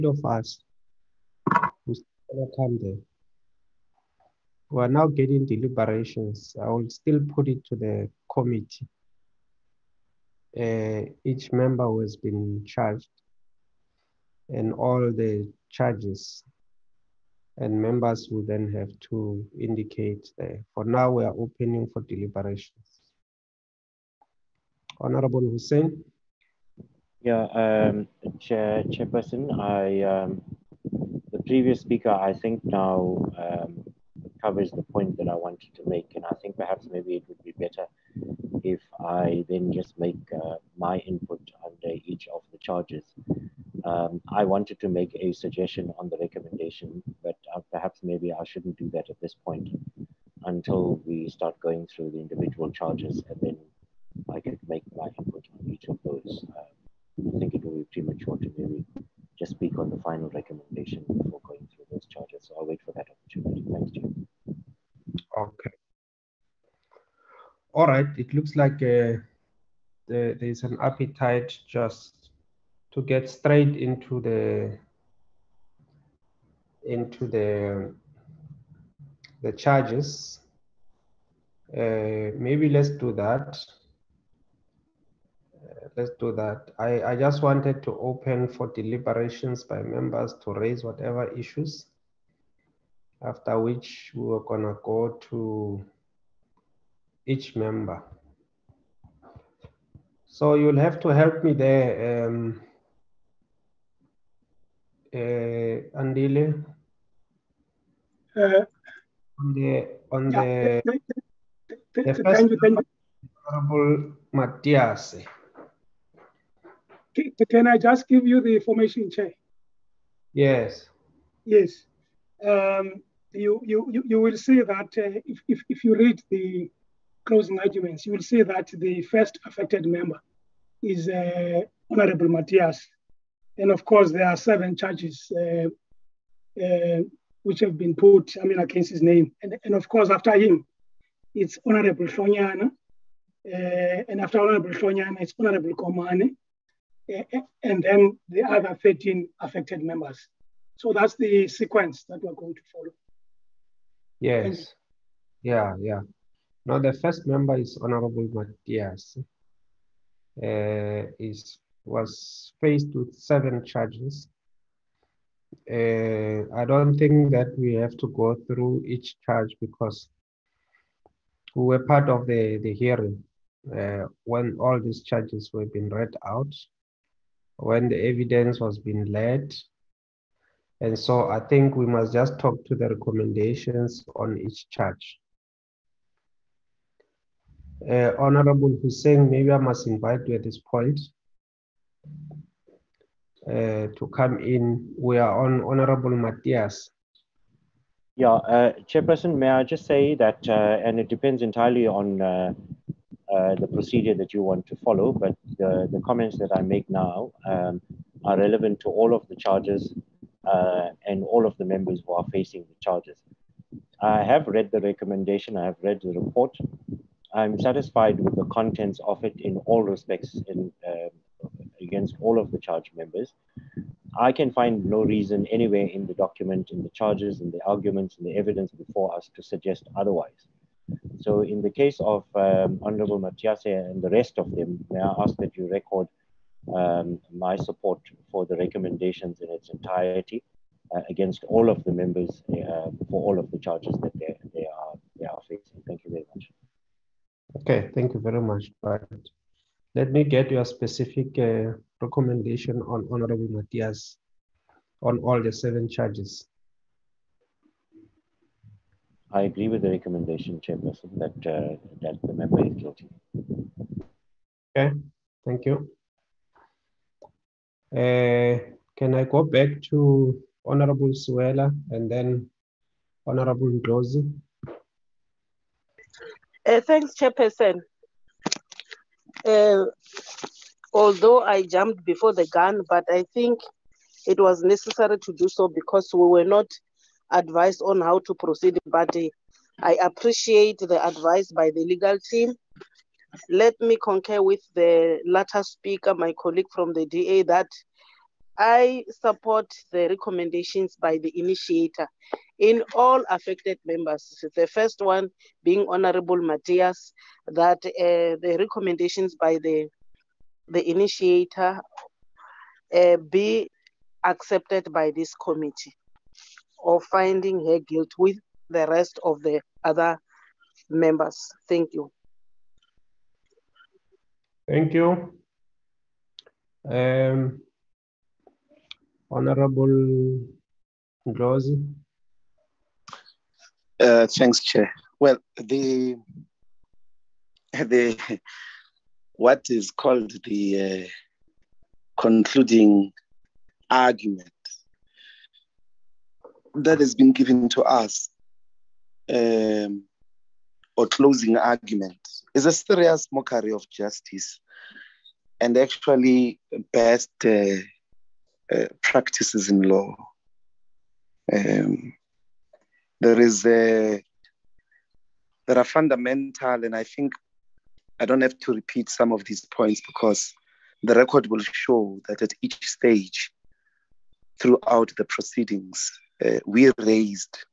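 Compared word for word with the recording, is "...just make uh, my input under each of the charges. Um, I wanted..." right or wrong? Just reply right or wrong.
right.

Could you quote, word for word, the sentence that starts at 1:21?
Uh, maybe let's do that let's do that.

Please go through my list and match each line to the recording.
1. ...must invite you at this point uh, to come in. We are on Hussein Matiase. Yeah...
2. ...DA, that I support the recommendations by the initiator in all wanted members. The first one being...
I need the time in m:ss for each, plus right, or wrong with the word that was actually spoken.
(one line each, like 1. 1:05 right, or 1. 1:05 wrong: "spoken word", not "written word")
1. 3:09 wrong: "Honorable", not "Hussein"
2. 4:57 wrong: "affected", not "wanted".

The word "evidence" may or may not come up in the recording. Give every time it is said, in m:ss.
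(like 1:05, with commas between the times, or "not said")
2:57, 3:48.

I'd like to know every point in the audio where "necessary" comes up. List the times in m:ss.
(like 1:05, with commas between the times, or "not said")
4:44.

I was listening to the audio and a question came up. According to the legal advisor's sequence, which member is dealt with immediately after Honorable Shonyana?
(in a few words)
Komane.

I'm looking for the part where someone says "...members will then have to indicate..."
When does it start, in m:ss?
0:17.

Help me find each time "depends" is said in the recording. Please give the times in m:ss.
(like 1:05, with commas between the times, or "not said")
3:21.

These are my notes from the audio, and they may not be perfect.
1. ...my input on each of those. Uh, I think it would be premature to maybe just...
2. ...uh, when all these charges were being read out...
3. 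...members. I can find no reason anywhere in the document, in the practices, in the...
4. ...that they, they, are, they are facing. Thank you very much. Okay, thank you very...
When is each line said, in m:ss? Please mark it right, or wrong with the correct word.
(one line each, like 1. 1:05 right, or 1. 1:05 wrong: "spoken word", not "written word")
1. 0:54 right
2. 2:53 right
3. 3:42 wrong: "charges", not "practices"
4. 4:04 right.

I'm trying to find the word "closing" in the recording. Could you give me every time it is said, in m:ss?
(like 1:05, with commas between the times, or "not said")
2:07, 5:51.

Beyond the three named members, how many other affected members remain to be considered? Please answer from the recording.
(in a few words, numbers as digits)
13.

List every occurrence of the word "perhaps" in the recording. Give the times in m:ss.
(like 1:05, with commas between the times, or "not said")
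0:36, 0:47.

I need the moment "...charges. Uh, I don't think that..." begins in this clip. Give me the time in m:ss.
2:43.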